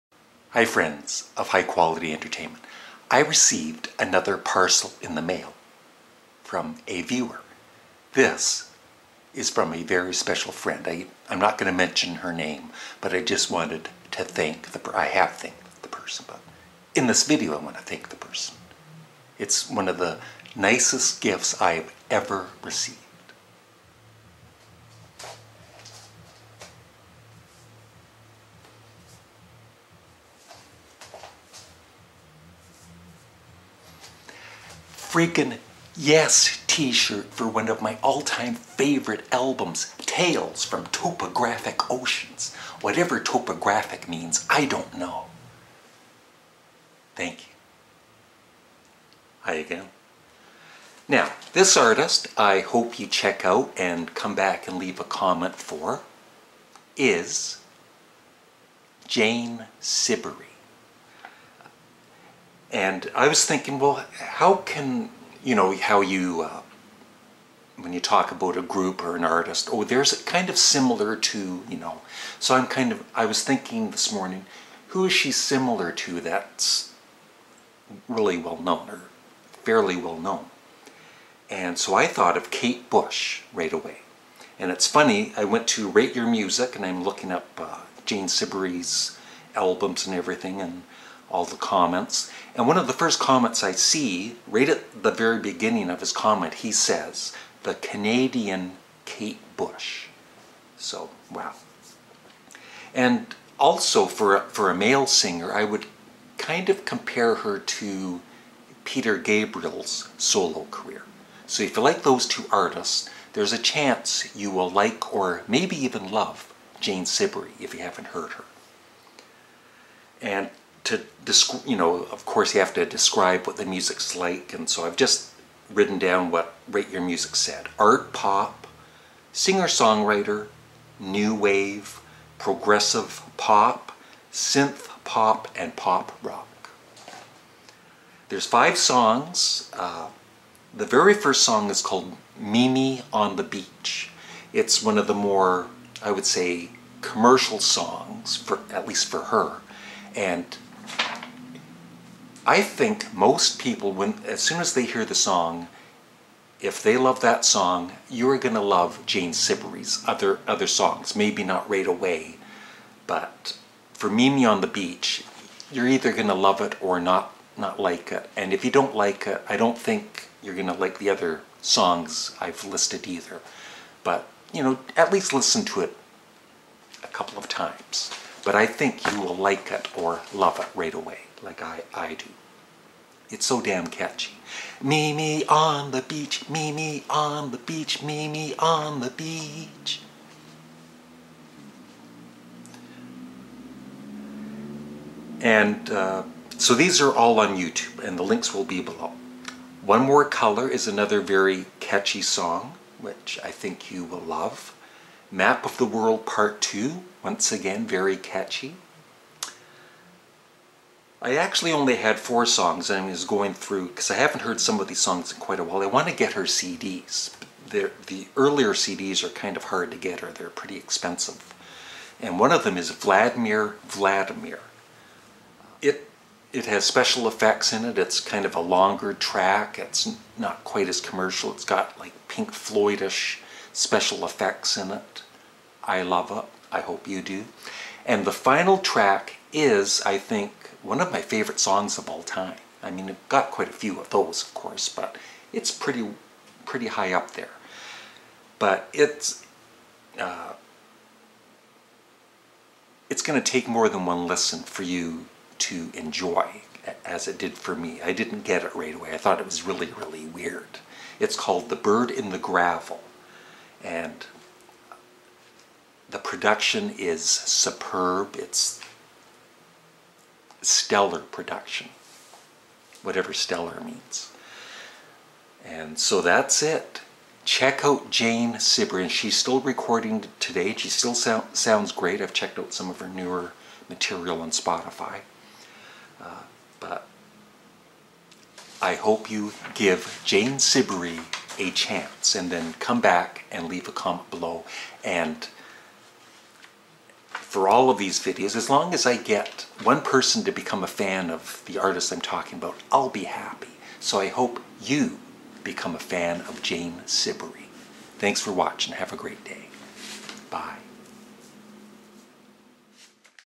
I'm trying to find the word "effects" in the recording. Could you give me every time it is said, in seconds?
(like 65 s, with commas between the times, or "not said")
227 s, 234 s.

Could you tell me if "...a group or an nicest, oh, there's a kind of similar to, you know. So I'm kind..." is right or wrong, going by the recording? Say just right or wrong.
wrong.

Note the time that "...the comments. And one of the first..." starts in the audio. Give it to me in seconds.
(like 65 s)
91 s.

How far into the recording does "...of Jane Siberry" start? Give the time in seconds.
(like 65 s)
306 s.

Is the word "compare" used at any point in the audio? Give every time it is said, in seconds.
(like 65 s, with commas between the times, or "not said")
106 s.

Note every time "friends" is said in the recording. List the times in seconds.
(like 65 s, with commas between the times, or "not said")
0 s, 10 s.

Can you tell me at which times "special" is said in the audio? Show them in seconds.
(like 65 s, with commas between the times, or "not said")
10 s, 226 s, 233 s.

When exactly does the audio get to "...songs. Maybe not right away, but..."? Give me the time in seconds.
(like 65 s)
160 s.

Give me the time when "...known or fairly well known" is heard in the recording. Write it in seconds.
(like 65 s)
78 s.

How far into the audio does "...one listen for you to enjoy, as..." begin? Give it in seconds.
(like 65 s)
254 s.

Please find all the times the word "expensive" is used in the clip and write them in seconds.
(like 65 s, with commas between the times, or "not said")
220 s.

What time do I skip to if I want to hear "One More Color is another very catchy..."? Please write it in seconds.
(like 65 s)
199 s.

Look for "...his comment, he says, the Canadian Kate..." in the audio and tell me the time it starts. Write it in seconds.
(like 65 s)
96 s.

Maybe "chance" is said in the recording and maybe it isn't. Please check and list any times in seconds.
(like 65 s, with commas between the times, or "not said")
113 s, 291 s.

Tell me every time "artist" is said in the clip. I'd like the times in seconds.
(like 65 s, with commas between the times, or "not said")
51 s, 69 s, 112 s, 301 s.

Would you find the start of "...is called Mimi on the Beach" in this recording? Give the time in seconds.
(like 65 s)
141 s.